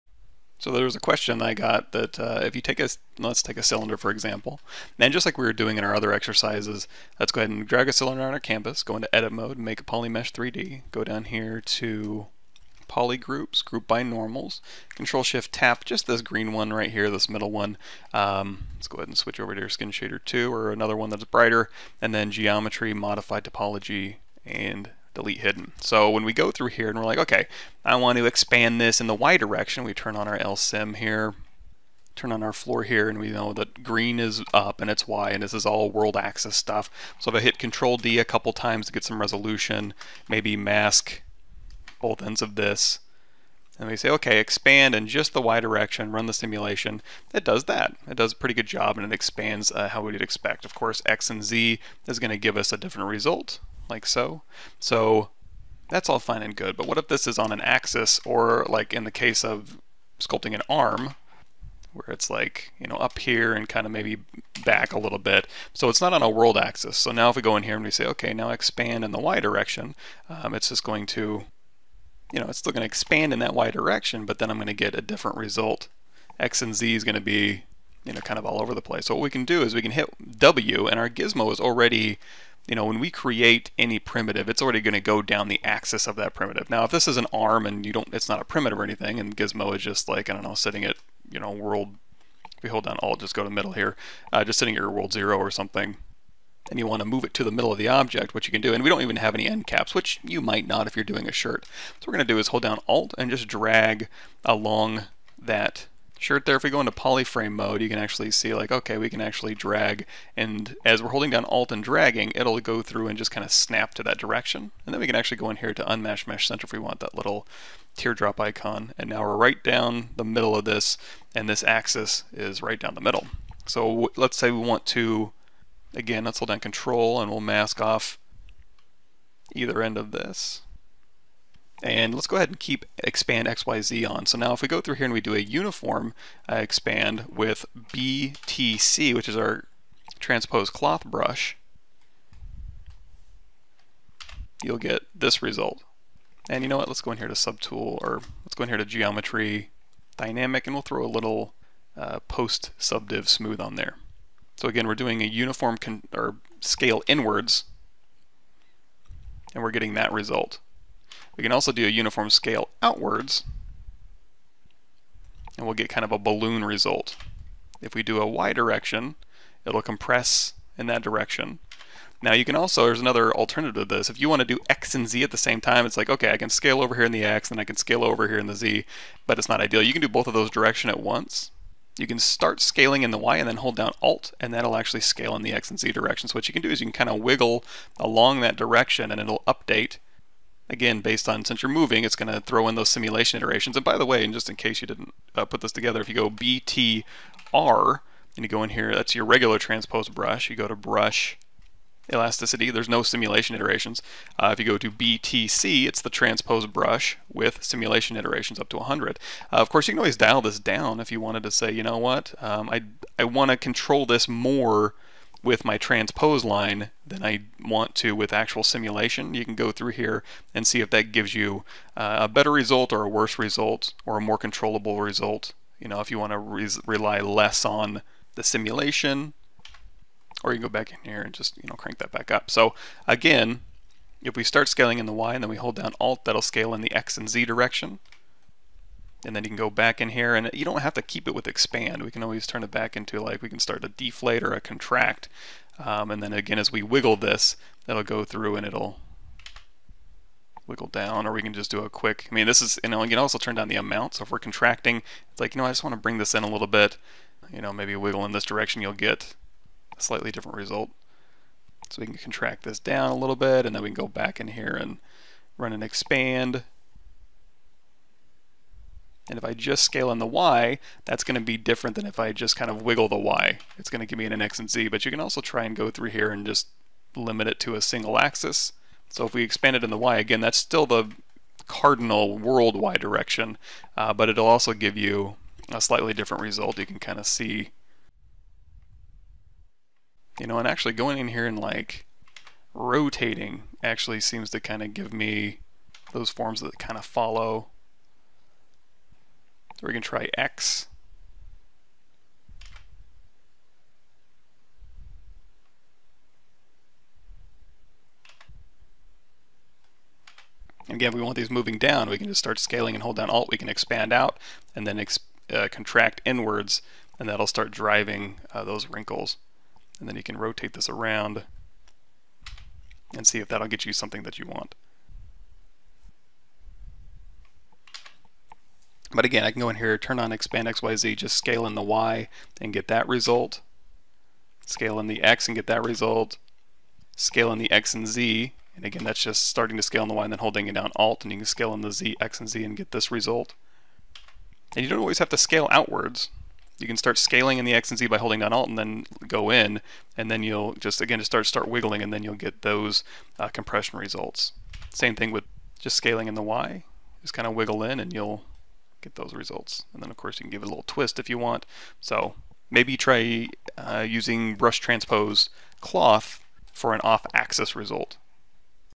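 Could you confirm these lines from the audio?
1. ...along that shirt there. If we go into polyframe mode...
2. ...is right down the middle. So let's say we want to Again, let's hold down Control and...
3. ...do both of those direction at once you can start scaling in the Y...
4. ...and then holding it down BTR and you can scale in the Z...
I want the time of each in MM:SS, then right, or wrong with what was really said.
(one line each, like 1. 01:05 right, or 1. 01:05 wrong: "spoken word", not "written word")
1. 01:44 right
2. 02:02 right
3. 03:00 right
4. 05:40 wrong: "Alt", not "BTR".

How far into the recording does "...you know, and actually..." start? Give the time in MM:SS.
04:50.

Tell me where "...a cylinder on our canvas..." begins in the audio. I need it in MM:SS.
00:07.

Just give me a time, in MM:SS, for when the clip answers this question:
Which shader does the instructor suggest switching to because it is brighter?
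00:19.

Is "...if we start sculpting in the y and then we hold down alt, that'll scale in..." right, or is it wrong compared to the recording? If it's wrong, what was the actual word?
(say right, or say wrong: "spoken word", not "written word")
wrong: "scaling", not "sculpting".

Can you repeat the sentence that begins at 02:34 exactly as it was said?
So again, we're doing a uniform or scale inwards, and we're getting that result.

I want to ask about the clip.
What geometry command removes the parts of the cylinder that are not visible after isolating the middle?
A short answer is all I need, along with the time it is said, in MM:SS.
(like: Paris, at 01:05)
Delete hidden, at 00:25.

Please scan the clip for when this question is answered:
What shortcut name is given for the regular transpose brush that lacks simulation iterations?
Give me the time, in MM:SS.
03:16.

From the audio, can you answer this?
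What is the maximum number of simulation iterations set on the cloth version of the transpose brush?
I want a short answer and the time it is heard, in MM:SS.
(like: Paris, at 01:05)
100, at 03:28.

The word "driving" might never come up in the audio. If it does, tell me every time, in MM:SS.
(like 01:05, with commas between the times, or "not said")
05:17.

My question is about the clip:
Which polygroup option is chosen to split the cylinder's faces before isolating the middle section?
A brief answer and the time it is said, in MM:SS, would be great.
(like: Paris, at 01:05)
Group by normals, at 00:13.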